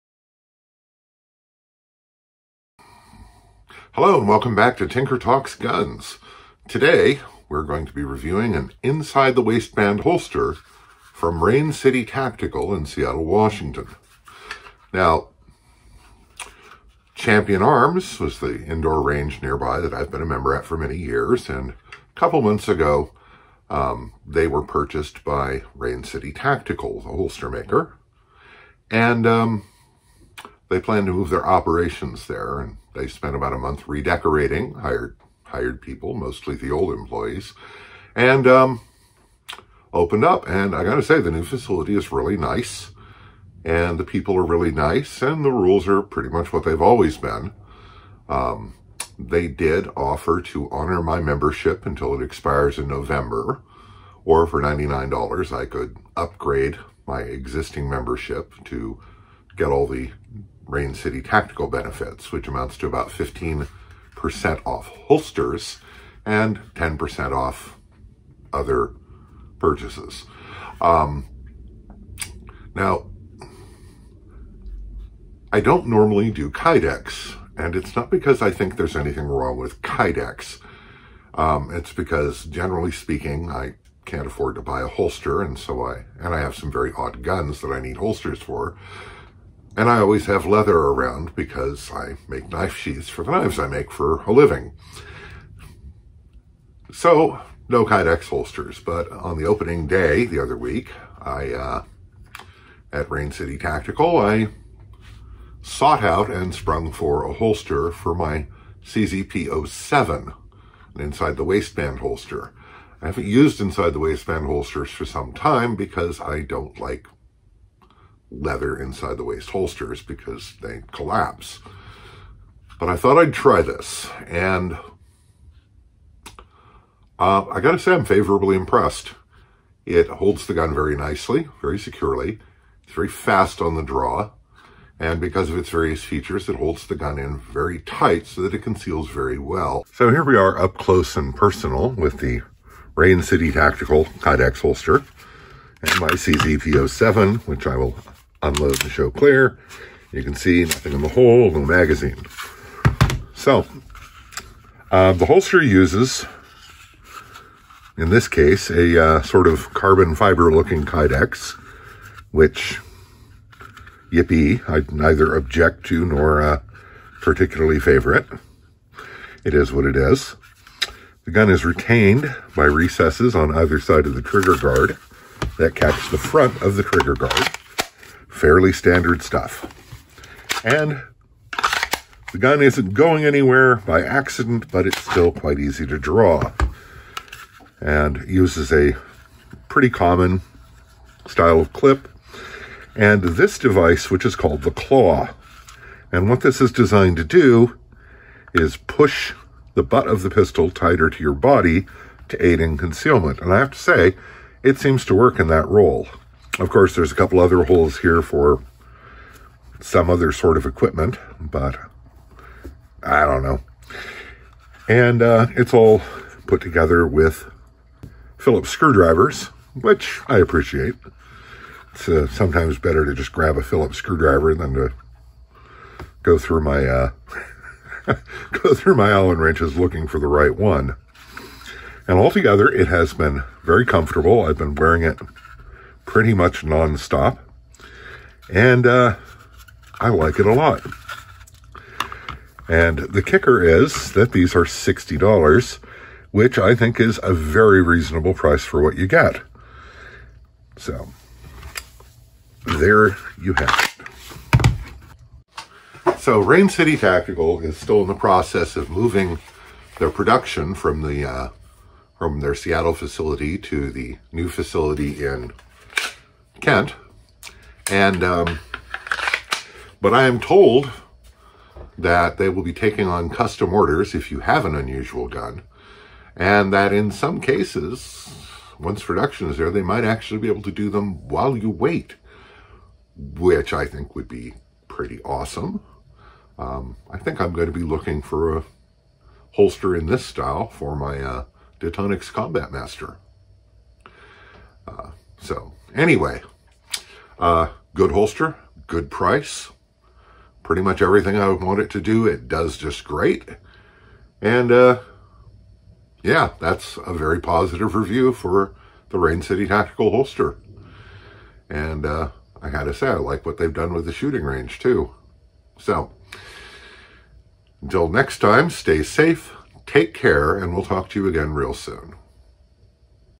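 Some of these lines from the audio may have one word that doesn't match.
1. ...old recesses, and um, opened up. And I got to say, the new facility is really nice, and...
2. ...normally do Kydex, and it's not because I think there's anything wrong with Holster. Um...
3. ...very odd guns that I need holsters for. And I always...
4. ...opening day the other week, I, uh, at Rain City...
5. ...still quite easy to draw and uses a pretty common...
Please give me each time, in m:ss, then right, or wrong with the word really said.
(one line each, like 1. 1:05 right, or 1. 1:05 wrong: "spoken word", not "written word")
1. 0:36 wrong: "employees", not "recesses"
2. 1:15 wrong: "Kydex", not "Holster"
3. 1:26 right
4. 1:39 right
5. 3:05 right.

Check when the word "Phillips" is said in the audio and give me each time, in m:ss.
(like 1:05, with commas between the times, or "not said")
3:38, 3:43.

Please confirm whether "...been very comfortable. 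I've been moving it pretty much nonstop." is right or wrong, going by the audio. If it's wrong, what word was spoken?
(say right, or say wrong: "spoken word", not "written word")
wrong: "wearing", not "moving".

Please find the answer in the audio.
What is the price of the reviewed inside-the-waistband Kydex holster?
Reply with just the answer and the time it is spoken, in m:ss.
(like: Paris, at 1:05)
$60, at 4:04.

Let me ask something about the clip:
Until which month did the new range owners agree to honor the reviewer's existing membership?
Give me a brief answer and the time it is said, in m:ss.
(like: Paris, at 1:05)
November, at 0:52.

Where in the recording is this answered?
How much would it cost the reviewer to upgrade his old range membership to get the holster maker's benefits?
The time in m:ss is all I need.
0:54.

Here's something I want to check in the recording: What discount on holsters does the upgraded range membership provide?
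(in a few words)
15%.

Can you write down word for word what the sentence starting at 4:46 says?
Um, I think I'm going to be looking for a holster in this style for my uh, Combat Master.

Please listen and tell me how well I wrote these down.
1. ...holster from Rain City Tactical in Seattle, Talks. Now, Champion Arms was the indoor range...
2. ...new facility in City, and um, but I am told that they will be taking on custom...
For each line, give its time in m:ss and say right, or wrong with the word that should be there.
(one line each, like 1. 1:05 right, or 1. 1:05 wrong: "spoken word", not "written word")
1. 0:10 wrong: "Washington", not "Talks"
2. 4:24 wrong: "Kent", not "City".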